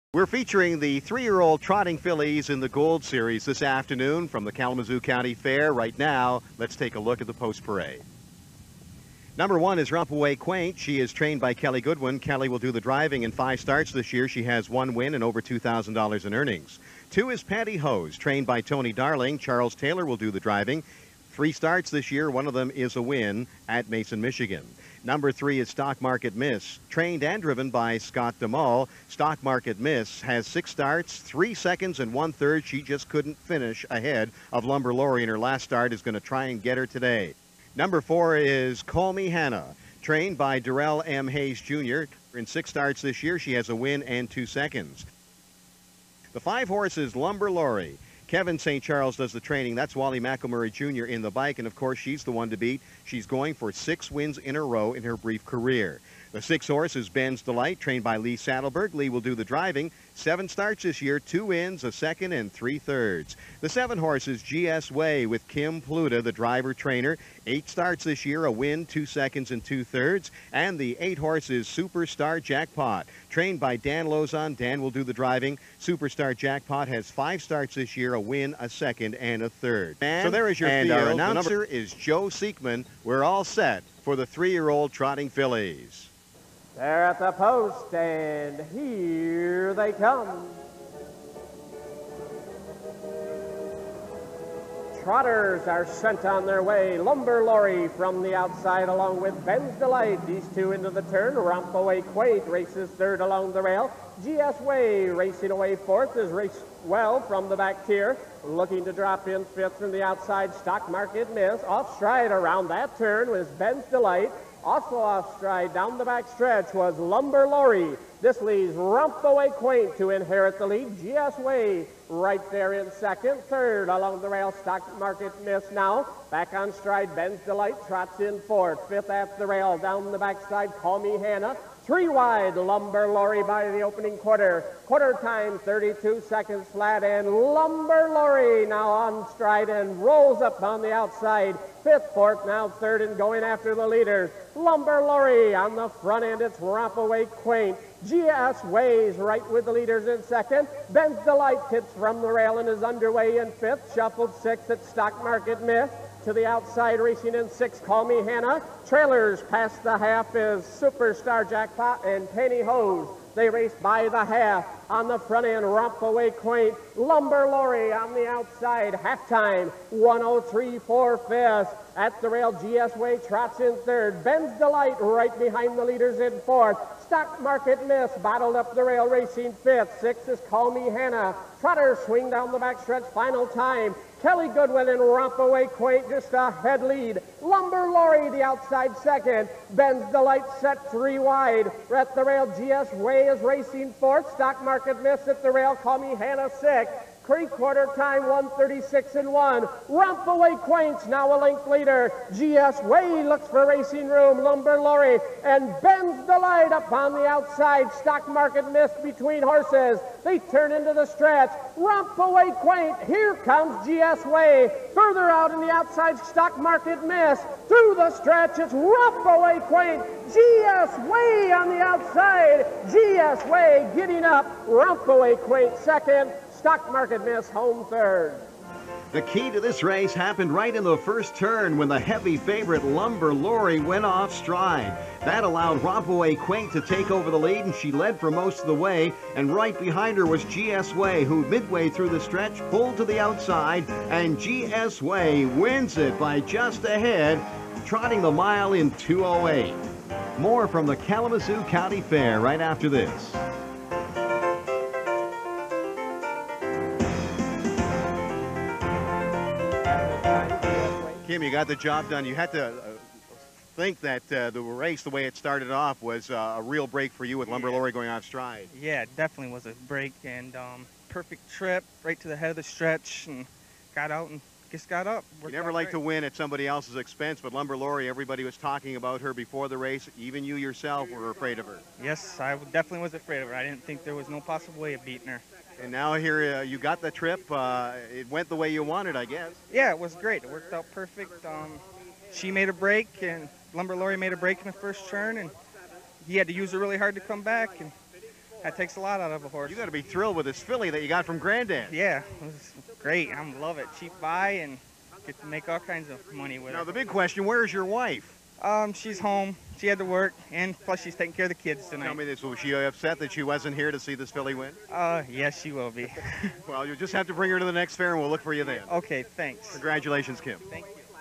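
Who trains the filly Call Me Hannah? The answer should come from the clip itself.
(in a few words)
Darrell M. Hayes Jr.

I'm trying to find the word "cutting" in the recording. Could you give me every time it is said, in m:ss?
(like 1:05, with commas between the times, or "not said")
not said.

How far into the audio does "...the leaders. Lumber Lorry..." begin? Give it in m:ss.
2:23.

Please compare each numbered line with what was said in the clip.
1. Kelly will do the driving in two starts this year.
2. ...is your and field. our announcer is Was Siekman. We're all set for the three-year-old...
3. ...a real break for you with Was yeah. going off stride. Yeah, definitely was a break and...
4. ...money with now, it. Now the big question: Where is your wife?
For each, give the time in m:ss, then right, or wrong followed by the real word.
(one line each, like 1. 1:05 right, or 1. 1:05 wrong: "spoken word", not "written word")
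1. 0:12 wrong: "five", not "two"
2. 1:20 wrong: "Joe", not "Was"
3. 4:26 wrong: "Lumber", not "Was"
4. 5:06 right.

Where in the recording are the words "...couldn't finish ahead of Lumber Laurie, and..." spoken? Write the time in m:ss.
0:33.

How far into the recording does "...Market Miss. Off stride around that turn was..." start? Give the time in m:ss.
1:50.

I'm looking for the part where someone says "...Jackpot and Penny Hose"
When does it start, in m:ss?
2:41.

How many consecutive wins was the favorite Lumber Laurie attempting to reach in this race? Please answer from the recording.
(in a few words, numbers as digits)
6.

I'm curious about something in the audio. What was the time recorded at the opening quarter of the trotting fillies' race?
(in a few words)
32 seconds flat.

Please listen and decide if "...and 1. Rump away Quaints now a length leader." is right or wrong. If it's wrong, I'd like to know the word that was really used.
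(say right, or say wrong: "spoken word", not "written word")
right.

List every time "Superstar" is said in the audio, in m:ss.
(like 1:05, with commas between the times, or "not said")
1:11, 1:15, 2:40.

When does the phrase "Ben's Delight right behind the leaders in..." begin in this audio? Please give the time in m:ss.
2:54.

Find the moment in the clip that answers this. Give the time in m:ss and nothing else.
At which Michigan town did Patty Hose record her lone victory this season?
0:23.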